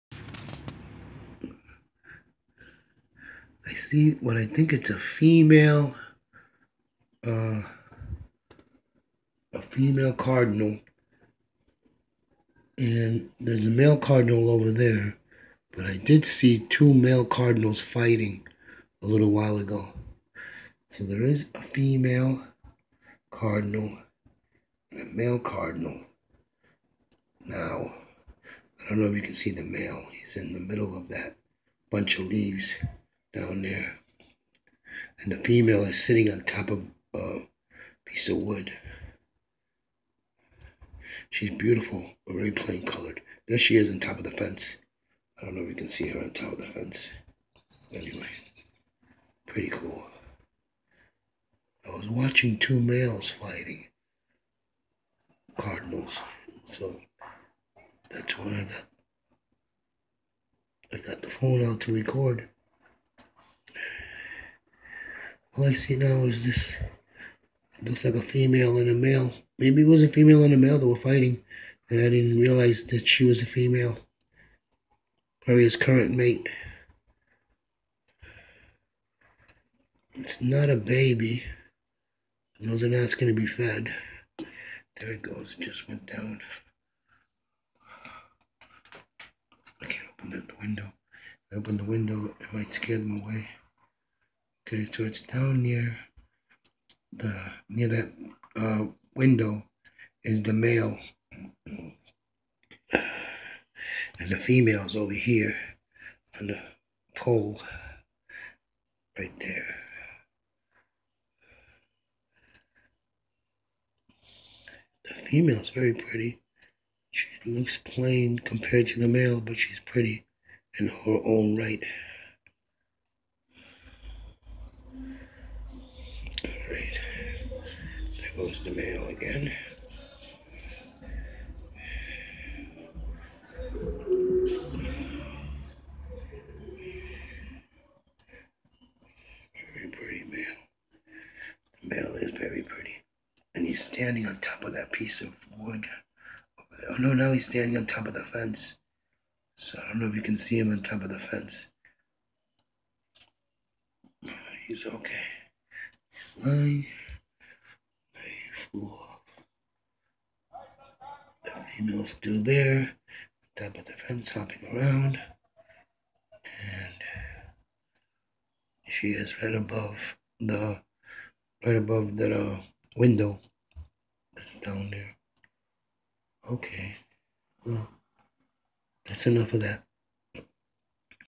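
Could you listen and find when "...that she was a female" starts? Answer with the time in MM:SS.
01:12.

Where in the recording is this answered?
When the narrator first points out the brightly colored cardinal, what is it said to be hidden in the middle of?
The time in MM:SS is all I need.
00:31.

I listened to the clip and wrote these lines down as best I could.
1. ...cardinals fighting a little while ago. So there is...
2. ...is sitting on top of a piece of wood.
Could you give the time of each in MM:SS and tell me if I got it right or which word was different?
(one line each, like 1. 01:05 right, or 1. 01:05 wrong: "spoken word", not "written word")
1. 00:17 right
2. 00:35 right.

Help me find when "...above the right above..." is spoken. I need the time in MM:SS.
02:49.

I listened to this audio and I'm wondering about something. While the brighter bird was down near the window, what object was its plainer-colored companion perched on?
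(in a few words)
pole.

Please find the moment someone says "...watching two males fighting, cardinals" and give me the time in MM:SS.
00:52.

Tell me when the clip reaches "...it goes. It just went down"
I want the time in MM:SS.
01:25.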